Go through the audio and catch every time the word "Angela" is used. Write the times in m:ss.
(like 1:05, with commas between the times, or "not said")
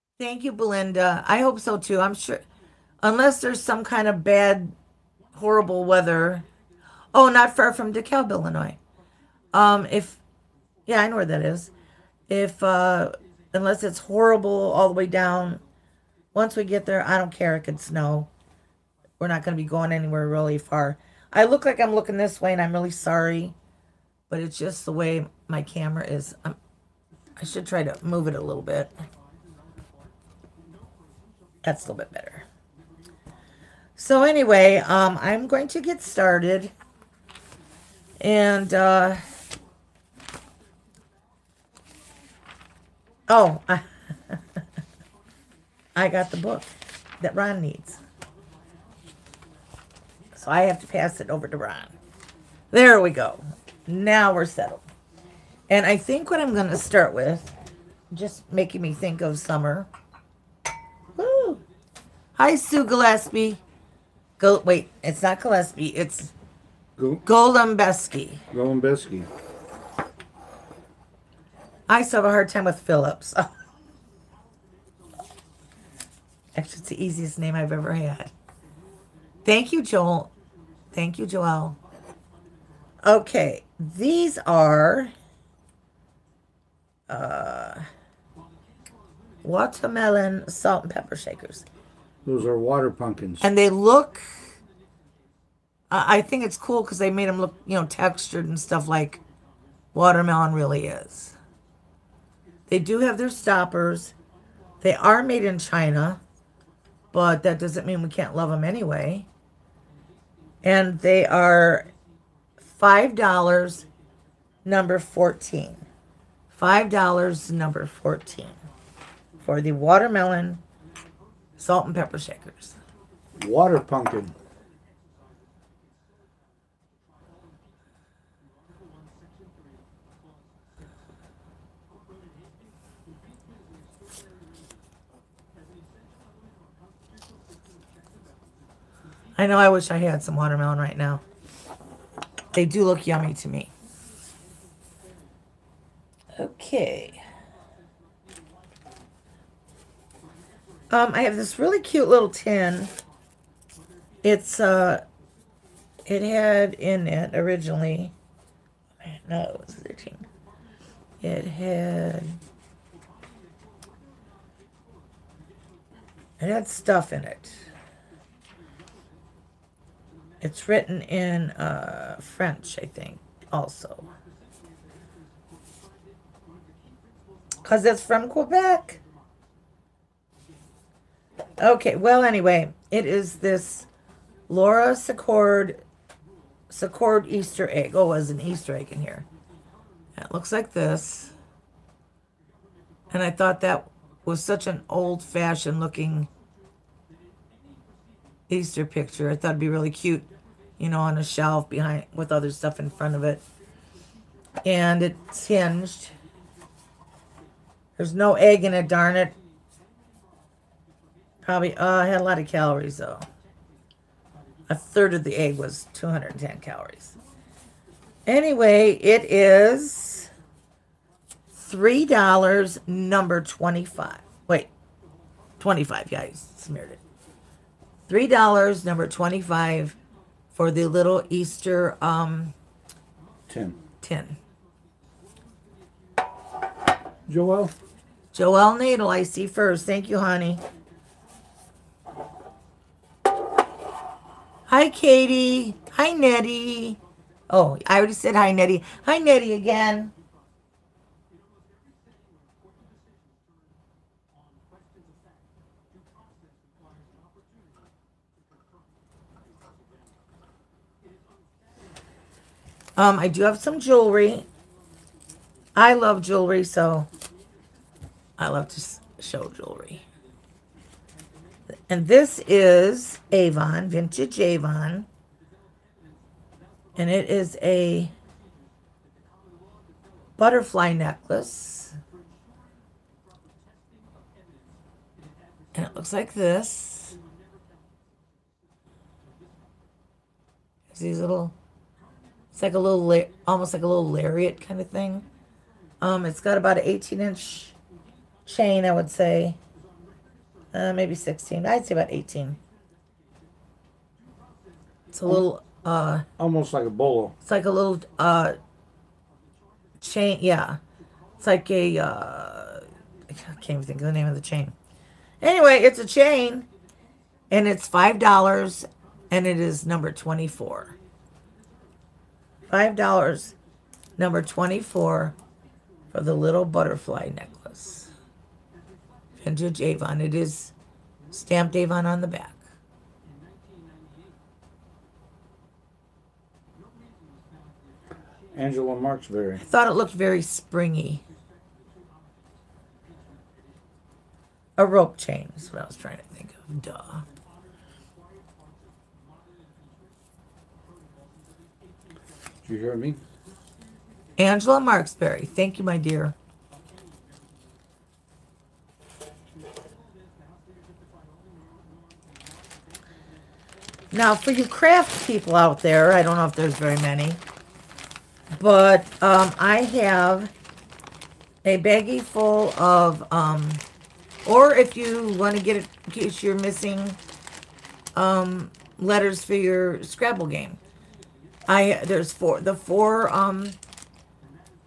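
5:38, 5:54.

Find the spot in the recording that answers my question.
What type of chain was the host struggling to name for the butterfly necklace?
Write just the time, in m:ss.
5:44.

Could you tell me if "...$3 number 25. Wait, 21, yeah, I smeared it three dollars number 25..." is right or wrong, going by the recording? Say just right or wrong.
wrong.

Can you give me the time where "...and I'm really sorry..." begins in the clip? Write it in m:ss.
0:22.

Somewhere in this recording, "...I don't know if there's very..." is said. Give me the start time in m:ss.
6:06.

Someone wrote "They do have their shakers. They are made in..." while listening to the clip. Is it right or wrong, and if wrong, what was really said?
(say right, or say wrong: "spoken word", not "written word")
wrong: "stoppers", not "shakers".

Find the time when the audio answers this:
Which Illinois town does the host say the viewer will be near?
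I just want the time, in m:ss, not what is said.
0:07.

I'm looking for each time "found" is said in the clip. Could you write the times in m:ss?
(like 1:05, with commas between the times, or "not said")
not said.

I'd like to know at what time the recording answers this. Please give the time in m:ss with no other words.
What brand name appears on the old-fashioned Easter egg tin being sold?
3:04.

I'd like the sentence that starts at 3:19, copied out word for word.
I thought it'd be really cute, you know, on a shelf behind with other stuff in front of it.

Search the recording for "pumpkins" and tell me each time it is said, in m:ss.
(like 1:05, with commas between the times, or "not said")
1:32, 2:03.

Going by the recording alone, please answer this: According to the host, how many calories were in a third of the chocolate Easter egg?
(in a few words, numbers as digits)
210.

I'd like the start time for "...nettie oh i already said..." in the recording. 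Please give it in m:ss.
4:06.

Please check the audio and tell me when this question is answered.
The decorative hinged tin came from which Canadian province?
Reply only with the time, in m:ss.
2:58.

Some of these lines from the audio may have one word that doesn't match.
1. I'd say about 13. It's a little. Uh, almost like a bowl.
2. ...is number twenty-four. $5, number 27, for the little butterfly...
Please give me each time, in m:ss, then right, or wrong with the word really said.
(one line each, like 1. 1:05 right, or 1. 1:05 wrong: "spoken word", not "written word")
1. 5:01 wrong: "18", not "13"
2. 5:19 wrong: "24", not "27".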